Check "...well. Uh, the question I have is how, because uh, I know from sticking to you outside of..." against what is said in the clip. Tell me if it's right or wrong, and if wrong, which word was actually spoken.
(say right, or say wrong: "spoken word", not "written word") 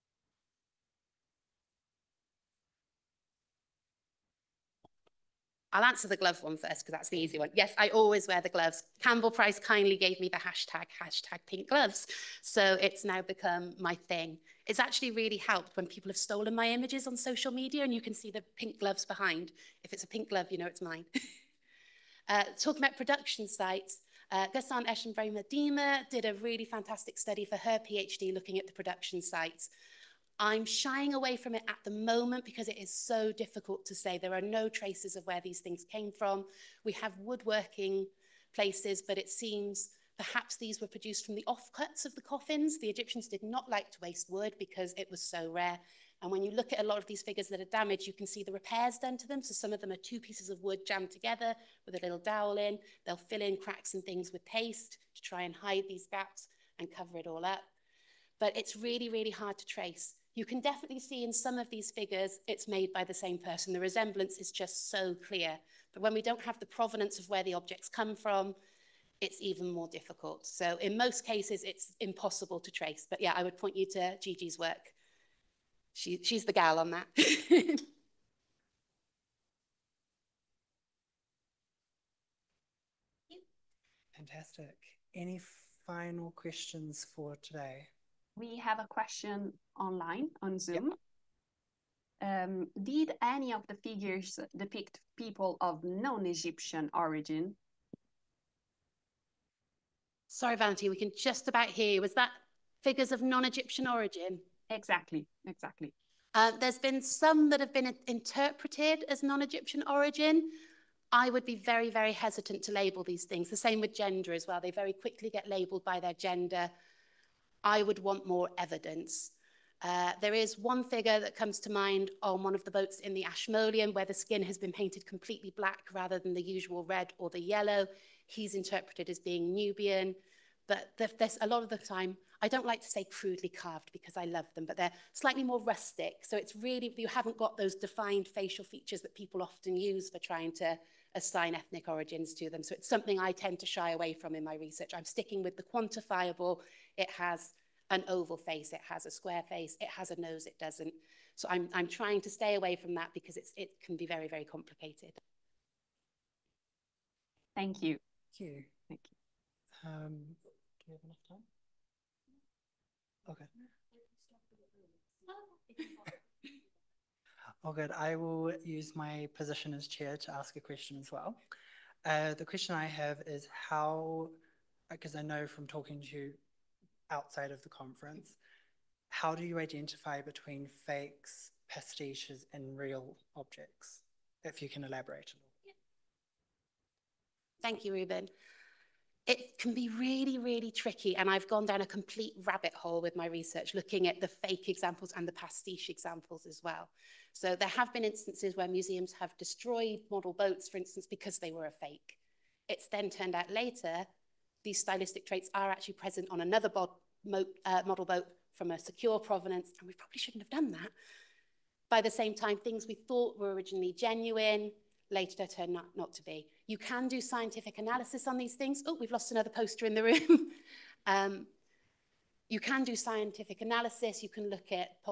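wrong: "talking", not "sticking".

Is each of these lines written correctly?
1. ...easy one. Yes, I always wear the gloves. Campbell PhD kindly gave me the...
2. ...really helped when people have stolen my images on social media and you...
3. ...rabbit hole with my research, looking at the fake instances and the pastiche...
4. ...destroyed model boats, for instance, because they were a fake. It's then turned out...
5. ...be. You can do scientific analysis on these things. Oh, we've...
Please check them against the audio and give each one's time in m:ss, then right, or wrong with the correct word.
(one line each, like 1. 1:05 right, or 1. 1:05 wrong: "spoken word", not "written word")
1. 0:07 wrong: "Price", not "PhD"
2. 0:15 right
3. 3:12 wrong: "examples", not "instances"
4. 3:19 right
5. 3:36 right.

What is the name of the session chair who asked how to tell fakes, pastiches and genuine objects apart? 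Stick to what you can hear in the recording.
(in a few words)
Ruben.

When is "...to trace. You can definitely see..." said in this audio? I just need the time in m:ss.
0:59.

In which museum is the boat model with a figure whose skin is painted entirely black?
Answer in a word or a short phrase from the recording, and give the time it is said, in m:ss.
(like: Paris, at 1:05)
Ashmolean, at 2:03.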